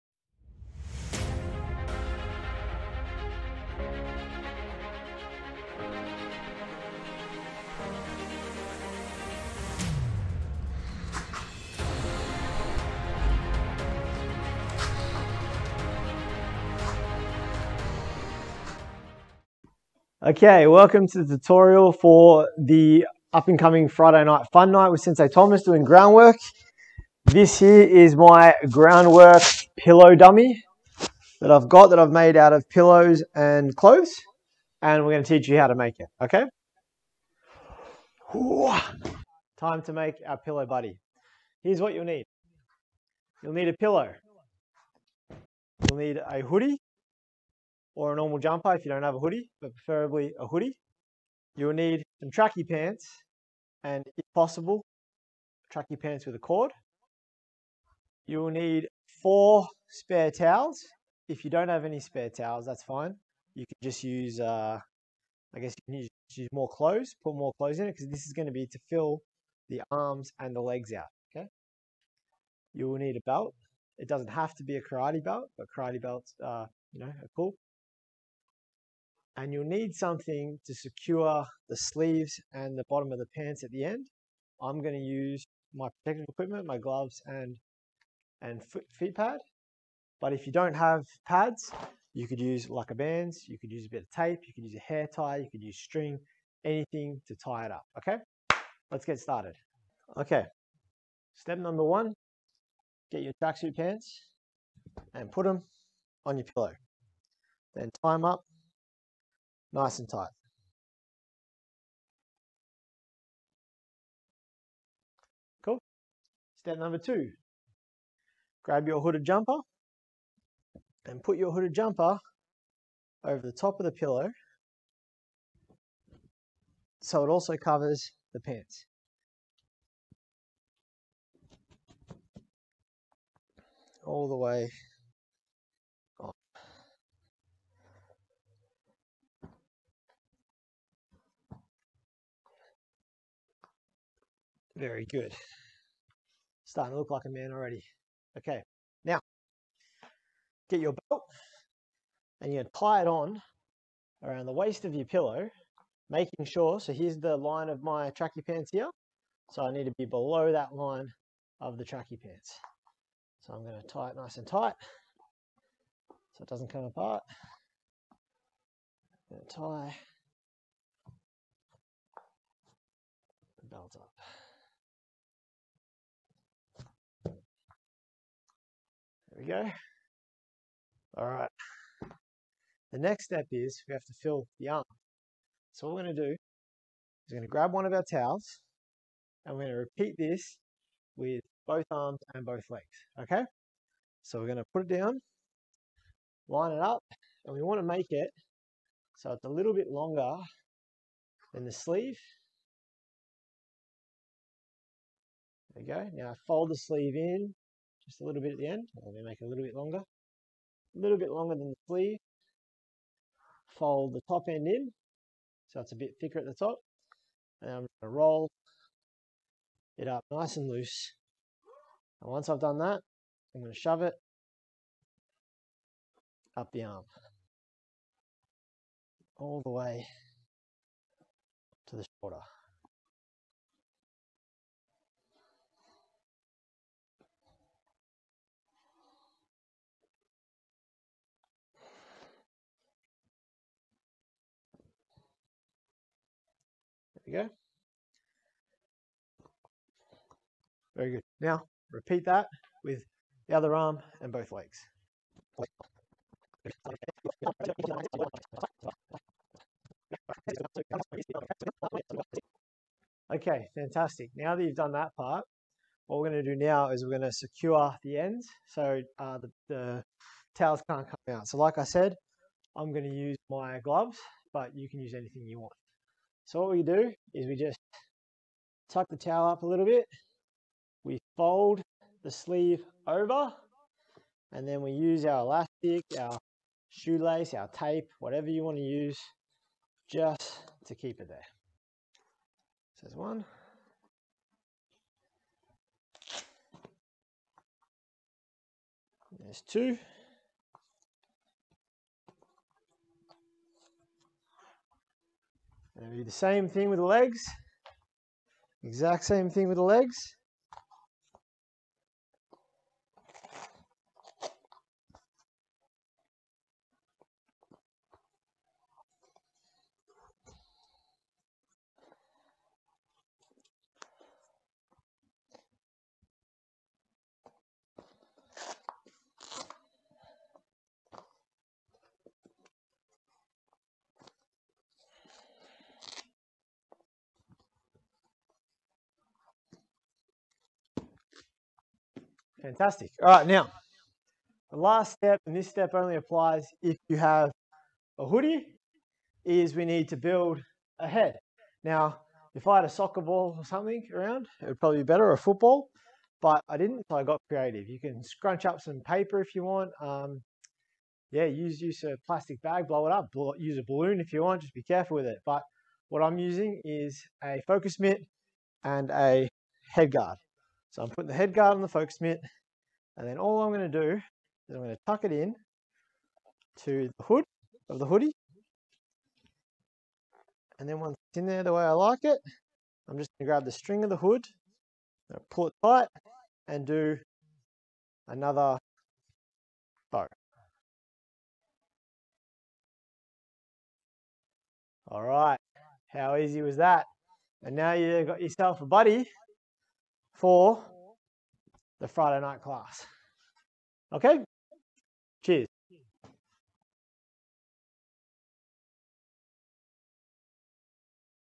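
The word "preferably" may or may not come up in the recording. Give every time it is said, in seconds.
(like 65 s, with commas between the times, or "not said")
49 s.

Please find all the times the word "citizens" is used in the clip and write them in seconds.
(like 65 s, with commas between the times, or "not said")
not said.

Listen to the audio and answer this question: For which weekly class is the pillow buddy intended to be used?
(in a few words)
Friday night class.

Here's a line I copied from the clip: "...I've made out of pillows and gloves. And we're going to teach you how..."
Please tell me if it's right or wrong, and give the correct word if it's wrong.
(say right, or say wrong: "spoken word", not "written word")
wrong: "clothes", not "gloves".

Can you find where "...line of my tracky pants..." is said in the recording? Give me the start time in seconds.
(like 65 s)
157 s.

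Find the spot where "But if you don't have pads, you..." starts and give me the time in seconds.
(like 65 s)
90 s.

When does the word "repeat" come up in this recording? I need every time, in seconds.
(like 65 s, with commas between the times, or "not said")
189 s, 251 s.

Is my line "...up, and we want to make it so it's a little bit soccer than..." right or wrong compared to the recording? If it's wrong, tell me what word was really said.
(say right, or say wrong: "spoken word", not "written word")
wrong: "longer", not "soccer".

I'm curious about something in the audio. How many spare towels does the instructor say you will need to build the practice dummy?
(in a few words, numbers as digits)
4.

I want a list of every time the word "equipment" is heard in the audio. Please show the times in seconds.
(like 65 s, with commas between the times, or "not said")
86 s.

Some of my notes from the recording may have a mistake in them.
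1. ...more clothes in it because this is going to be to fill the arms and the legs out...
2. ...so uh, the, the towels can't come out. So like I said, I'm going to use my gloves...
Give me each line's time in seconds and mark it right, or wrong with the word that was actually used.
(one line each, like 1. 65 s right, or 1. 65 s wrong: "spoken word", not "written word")
1. 67 s right
2. 268 s right.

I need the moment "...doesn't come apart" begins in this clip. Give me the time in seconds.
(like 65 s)
166 s.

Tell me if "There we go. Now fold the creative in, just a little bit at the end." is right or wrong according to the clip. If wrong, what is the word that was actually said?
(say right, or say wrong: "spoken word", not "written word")
wrong: "sleeve", not "creative".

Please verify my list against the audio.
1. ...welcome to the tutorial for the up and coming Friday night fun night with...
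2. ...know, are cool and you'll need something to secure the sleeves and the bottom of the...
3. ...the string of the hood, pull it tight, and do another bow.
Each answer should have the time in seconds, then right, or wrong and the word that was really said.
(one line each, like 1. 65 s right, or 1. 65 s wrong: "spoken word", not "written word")
1. 20 s right
2. 76 s right
3. 383 s right.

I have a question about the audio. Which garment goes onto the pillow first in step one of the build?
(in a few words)
Tracksuit pants.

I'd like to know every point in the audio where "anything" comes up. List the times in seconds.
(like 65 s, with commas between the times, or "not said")
96 s, 275 s.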